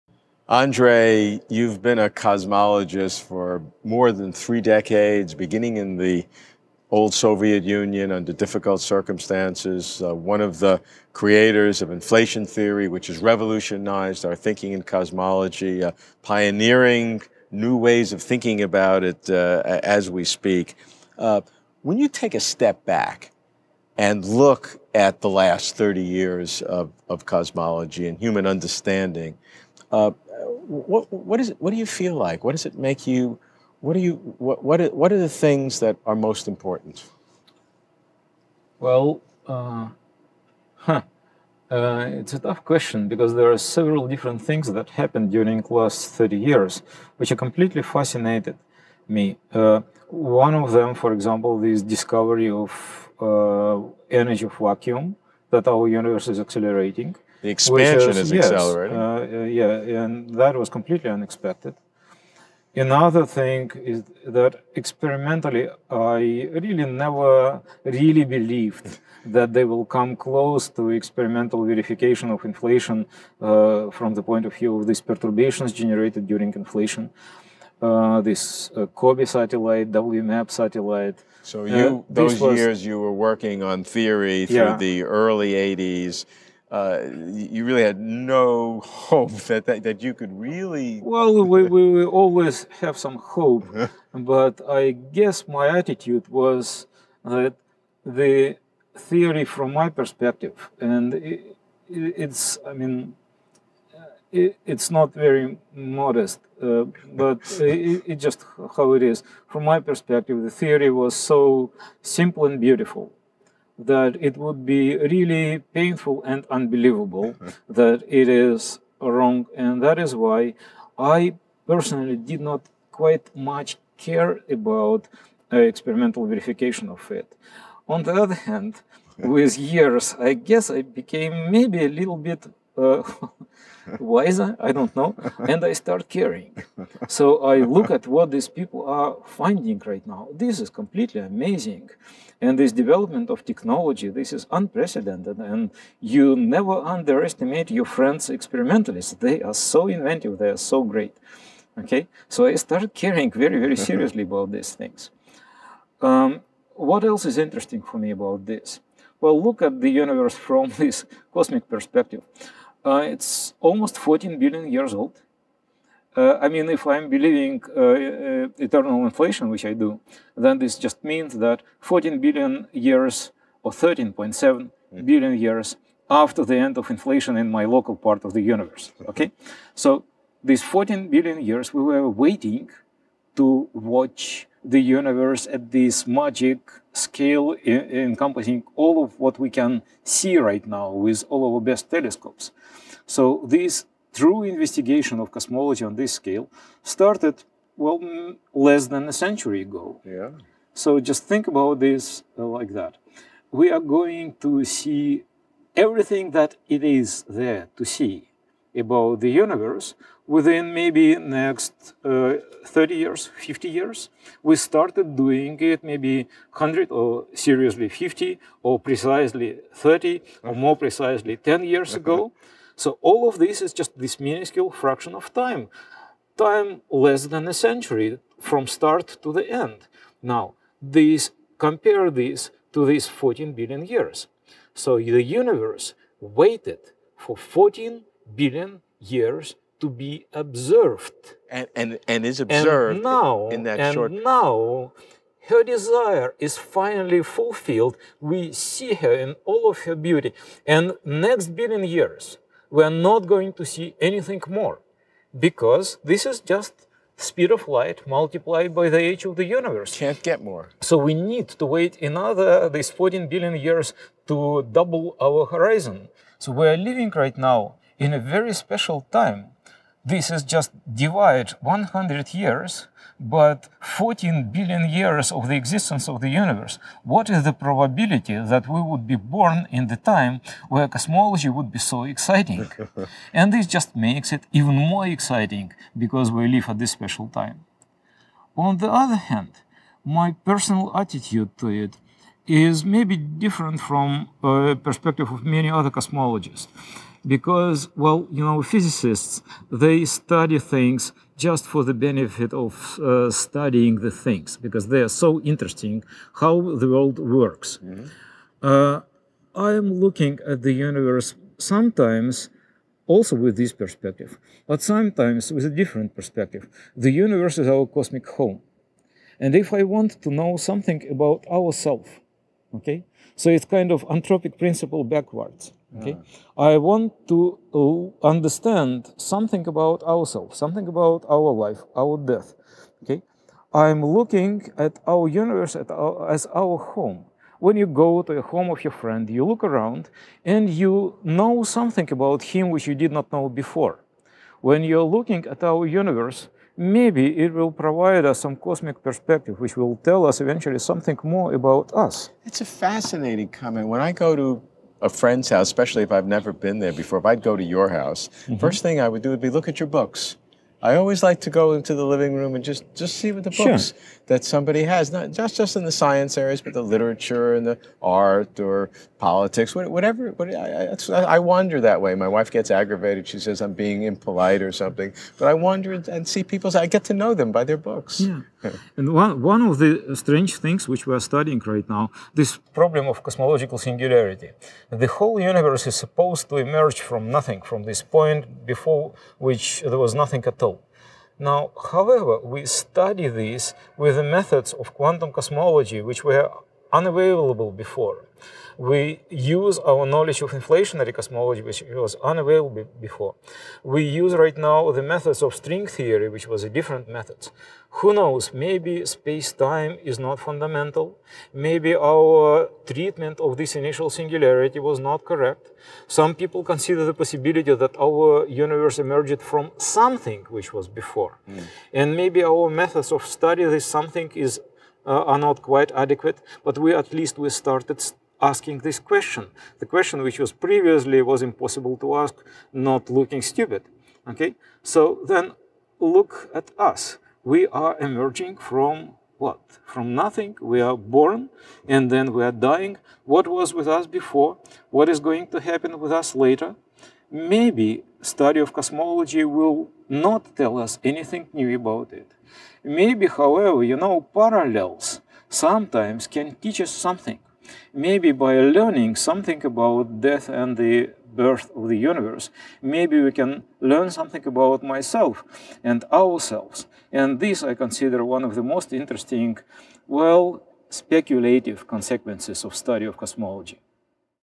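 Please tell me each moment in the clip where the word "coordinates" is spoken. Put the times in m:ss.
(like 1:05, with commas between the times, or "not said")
not said.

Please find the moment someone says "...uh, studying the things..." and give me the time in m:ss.
5:02.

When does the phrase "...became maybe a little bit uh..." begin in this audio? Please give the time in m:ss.
2:10.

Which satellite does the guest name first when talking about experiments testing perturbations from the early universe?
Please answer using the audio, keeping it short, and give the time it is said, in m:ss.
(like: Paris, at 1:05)
COBE, at 1:19.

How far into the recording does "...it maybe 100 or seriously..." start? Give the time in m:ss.
3:35.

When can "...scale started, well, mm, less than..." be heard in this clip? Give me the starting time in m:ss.
3:16.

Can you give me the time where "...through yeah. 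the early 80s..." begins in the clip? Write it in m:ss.
1:24.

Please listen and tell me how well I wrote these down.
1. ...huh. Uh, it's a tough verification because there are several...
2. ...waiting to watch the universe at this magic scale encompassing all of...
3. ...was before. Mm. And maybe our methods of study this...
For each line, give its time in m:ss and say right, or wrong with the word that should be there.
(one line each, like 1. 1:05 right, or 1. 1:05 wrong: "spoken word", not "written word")
1. 0:40 wrong: "question", not "verification"
2. 3:02 right
3. 7:00 right.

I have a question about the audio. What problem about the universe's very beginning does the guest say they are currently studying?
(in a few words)
cosmological singularity.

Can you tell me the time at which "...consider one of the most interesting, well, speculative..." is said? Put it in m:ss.
7:47.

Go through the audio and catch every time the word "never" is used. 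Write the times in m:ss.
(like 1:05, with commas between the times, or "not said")
1:06, 2:26, 5:56.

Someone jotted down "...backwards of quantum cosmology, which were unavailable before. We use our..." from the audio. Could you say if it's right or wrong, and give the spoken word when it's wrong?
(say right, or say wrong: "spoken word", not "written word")
wrong: "methods", not "backwards".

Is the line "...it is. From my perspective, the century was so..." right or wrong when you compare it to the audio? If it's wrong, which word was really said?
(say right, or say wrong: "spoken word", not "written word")
wrong: "theory", not "century".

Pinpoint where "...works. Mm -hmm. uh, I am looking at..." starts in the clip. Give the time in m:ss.
5:07.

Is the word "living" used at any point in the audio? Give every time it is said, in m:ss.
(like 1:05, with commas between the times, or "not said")
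4:26, 6:02.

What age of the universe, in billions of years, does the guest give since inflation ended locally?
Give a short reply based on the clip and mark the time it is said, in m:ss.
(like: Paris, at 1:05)
13.7 billion years, at 2:53.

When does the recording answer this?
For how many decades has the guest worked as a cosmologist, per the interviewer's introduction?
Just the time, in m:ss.
0:03.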